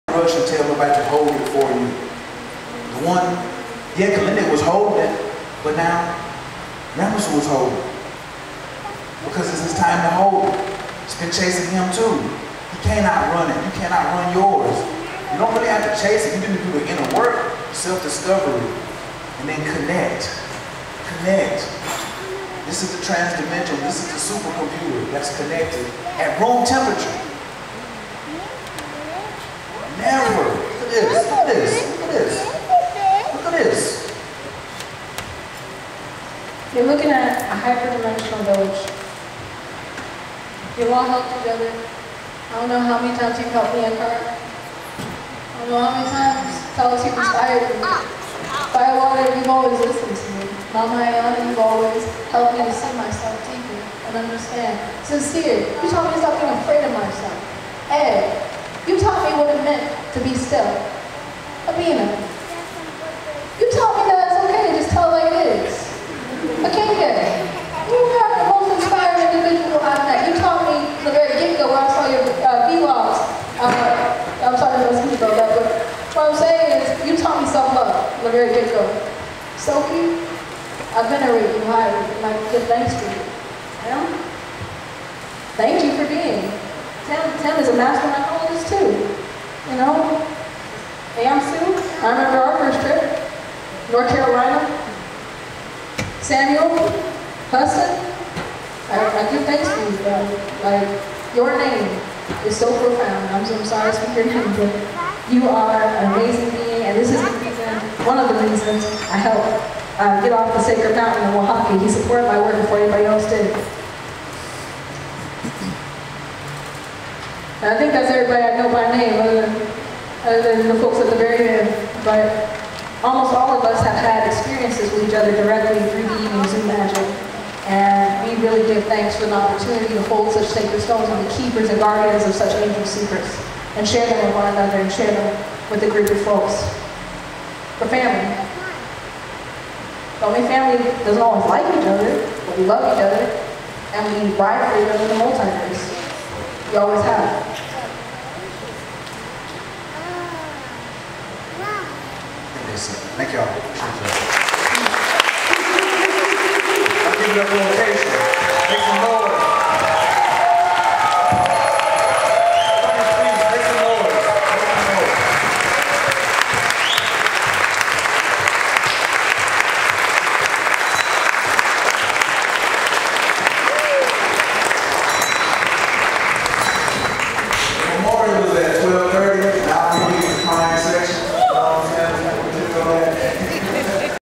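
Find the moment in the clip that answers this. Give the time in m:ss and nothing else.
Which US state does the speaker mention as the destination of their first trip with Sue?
1:33.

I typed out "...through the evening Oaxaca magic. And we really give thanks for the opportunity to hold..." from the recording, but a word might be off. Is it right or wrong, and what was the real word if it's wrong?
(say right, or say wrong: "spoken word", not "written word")
wrong: "Zoom", not "Oaxaca".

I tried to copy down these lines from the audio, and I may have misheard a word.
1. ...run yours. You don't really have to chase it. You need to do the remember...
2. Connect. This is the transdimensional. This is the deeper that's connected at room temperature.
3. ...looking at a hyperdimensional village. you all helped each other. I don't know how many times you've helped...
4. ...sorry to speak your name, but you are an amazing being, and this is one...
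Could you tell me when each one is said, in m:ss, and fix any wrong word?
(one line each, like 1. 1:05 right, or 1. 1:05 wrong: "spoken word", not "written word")
1. 0:14 wrong: "inner", not "remember"
2. 0:21 wrong: "supercomputer", not "deeper"
3. 0:36 right
4. 1:43 right.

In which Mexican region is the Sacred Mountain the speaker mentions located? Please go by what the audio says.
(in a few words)
Oaxaca.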